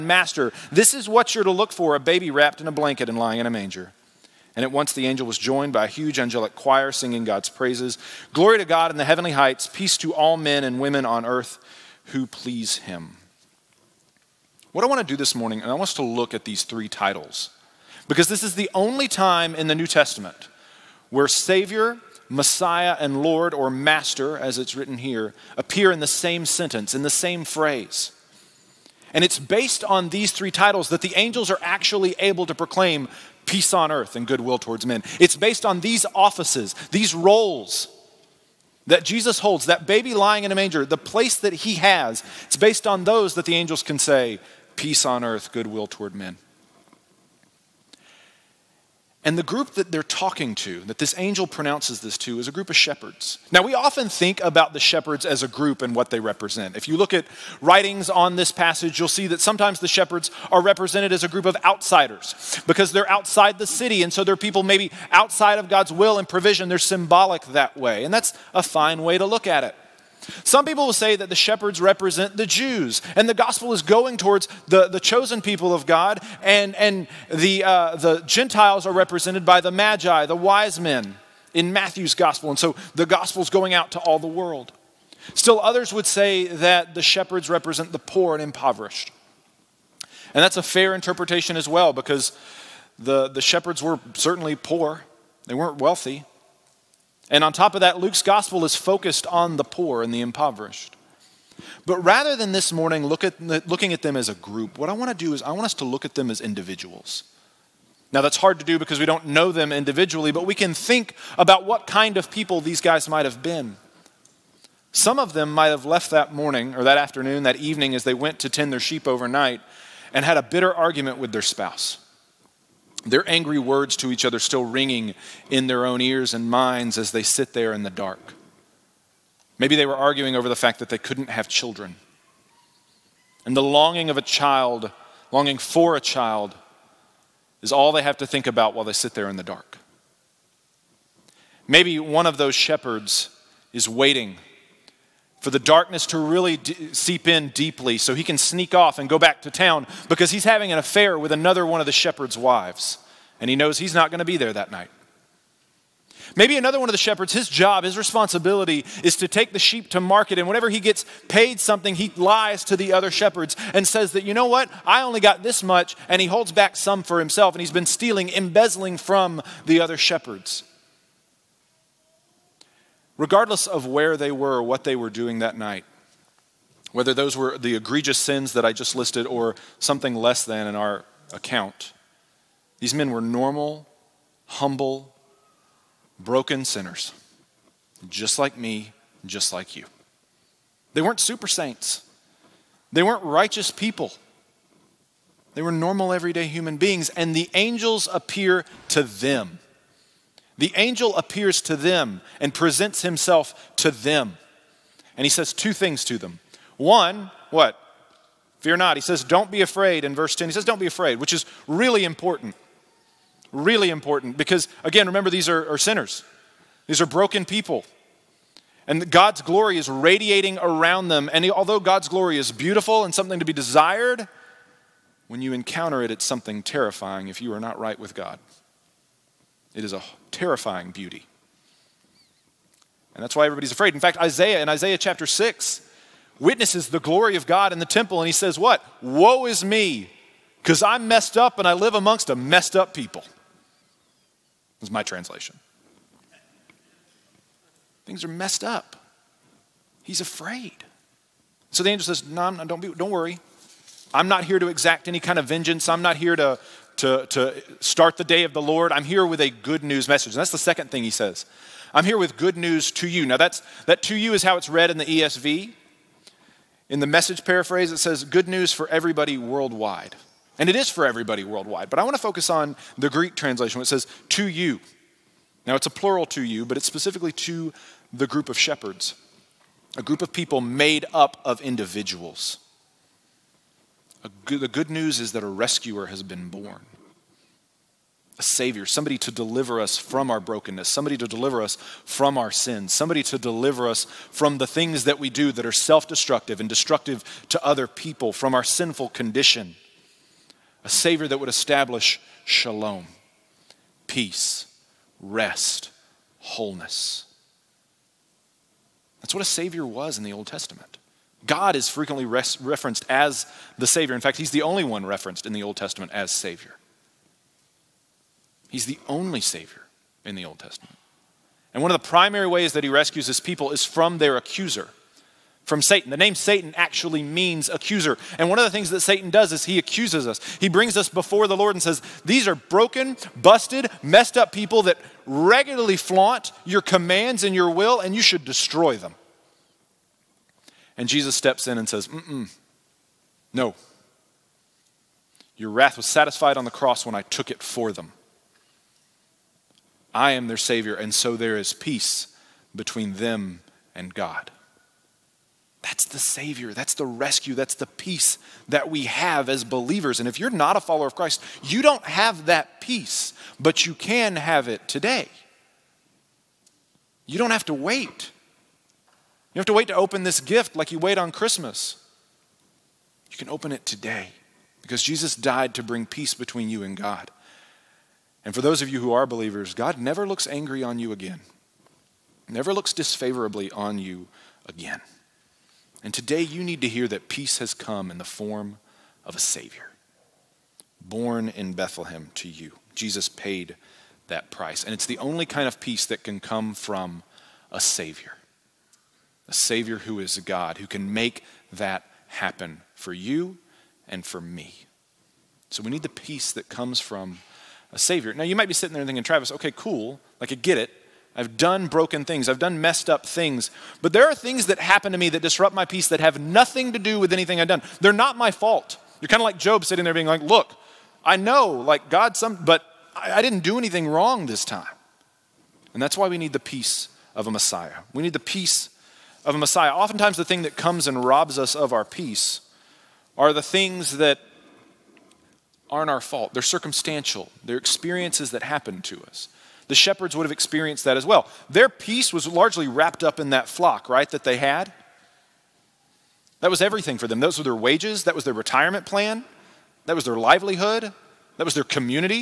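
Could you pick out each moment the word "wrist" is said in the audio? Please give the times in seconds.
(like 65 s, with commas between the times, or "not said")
not said.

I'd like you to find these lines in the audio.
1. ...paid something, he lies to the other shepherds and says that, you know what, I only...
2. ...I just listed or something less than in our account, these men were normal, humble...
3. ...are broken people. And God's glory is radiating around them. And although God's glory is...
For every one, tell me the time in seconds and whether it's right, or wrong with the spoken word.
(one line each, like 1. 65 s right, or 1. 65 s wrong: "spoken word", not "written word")
1. 161 s right
2. 178 s right
3. 217 s right.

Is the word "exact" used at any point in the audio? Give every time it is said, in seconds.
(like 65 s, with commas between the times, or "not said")
254 s.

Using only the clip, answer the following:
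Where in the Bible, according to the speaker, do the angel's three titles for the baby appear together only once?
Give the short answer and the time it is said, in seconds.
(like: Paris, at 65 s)
New Testament, at 19 s.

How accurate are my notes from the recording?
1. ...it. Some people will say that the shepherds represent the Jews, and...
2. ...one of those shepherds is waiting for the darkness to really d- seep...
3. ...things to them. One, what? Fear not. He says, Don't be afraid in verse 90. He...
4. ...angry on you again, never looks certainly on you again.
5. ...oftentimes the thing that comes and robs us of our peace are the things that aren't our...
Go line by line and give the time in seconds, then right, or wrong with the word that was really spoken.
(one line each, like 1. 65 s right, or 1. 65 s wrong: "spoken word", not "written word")
1. 69 s right
2. 141 s right
3. 205 s wrong: "10", not "90"
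4. 380 s wrong: "disfavorably", not "certainly"
5. 429 s right.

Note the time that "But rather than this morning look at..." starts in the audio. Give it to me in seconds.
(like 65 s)
101 s.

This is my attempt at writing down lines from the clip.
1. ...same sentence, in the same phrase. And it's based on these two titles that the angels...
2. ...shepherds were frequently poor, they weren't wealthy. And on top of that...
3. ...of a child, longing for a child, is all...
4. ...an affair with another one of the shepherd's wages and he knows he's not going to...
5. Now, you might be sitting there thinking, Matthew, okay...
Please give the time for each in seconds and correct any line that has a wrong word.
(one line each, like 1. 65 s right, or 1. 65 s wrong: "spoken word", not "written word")
1. 26 s wrong: "three", not "two"
2. 93 s wrong: "certainly", not "frequently"
3. 134 s right
4. 150 s wrong: "wives", not "wages"
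5. 408 s wrong: "Travis", not "Matthew".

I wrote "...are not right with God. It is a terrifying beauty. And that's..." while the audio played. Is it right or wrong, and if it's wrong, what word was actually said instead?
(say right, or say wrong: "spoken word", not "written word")
right.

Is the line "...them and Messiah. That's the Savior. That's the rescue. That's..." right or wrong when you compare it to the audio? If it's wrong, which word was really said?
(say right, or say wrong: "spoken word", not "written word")
wrong: "God", not "Messiah".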